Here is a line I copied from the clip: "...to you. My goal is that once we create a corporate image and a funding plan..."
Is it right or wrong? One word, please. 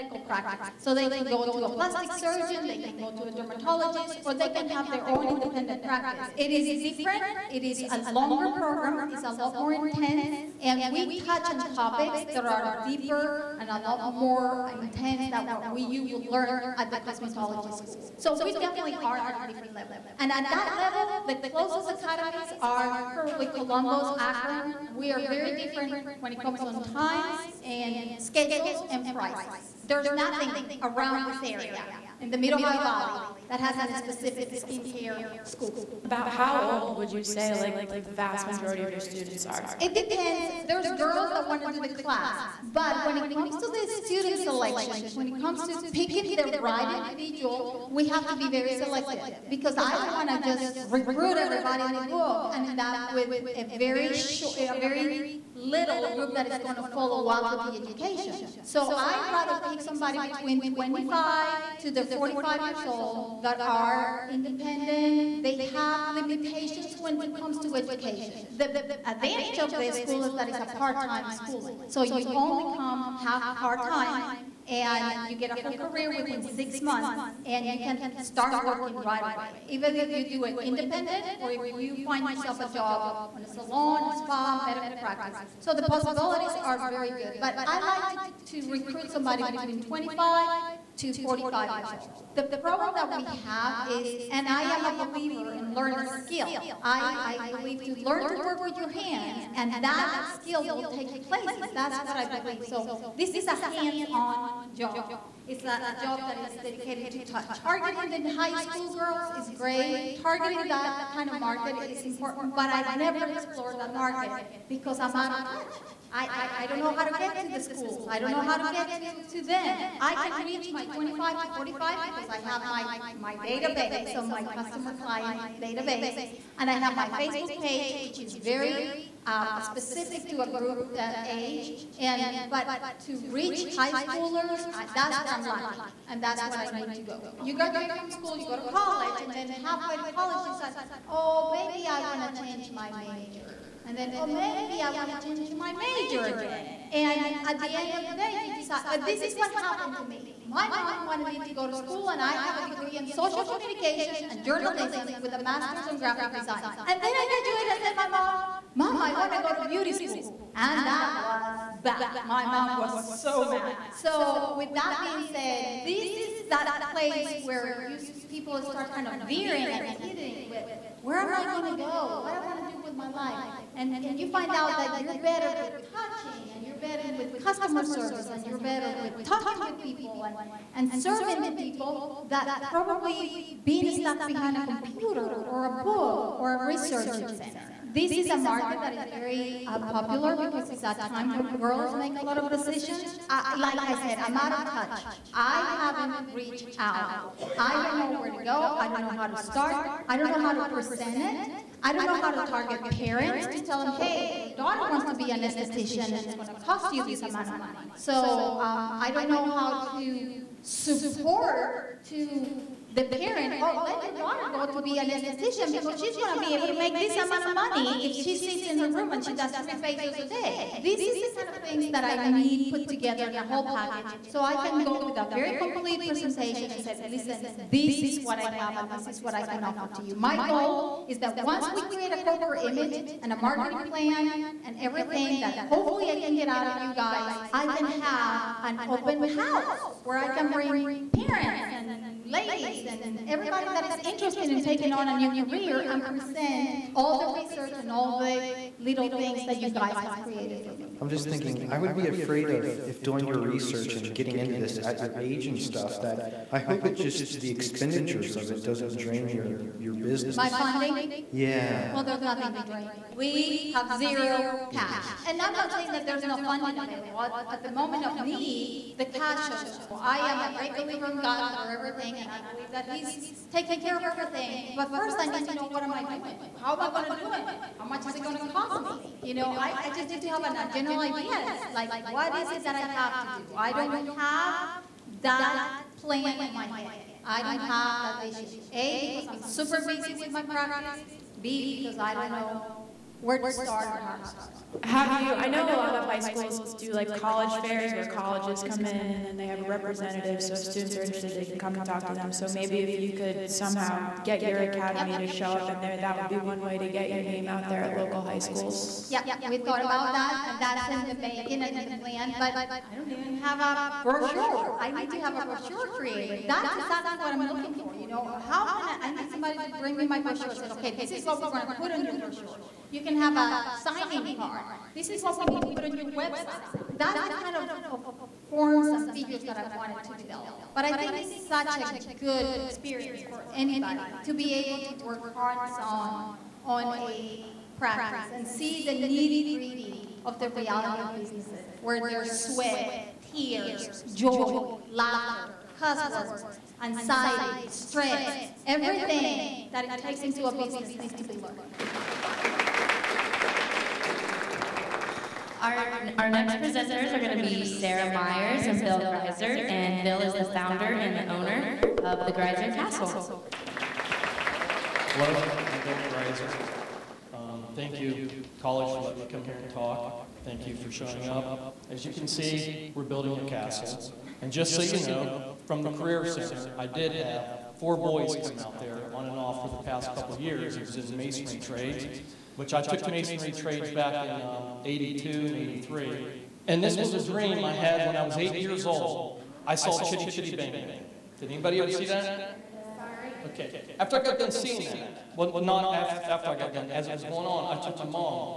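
wrong.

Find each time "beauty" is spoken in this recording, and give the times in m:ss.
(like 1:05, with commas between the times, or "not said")
2:39.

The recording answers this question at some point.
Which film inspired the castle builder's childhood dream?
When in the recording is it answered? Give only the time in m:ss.
6:30.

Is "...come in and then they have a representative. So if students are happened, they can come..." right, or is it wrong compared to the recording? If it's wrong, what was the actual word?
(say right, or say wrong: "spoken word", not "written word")
wrong: "interested", not "happened".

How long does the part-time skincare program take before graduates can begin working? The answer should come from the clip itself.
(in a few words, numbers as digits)
6 months.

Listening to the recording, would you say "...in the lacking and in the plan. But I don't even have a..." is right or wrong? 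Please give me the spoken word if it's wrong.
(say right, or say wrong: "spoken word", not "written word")
wrong: "making", not "lacking".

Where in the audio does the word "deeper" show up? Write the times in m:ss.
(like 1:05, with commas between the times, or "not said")
0:12.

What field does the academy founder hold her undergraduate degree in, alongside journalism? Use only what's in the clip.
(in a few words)
Social communication.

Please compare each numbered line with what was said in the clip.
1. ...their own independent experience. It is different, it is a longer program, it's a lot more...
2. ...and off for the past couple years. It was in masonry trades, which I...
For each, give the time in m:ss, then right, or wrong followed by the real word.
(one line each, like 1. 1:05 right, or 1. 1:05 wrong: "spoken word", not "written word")
1. 0:04 wrong: "practice", not "experience"
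2. 6:19 right.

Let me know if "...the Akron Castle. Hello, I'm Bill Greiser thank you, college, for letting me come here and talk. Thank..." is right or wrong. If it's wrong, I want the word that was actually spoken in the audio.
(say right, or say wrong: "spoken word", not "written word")
wrong: "Greiser", not "Akron".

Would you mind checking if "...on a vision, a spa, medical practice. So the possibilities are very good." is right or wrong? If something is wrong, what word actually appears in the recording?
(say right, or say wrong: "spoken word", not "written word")
wrong: "salon", not "vision".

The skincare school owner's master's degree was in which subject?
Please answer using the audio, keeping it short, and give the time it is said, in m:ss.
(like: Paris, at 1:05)
Graphic design, at 2:35.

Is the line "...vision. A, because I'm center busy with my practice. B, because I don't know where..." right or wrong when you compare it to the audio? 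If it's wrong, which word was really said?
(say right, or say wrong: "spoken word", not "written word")
wrong: "super", not "center".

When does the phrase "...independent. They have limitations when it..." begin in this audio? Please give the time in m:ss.
1:04.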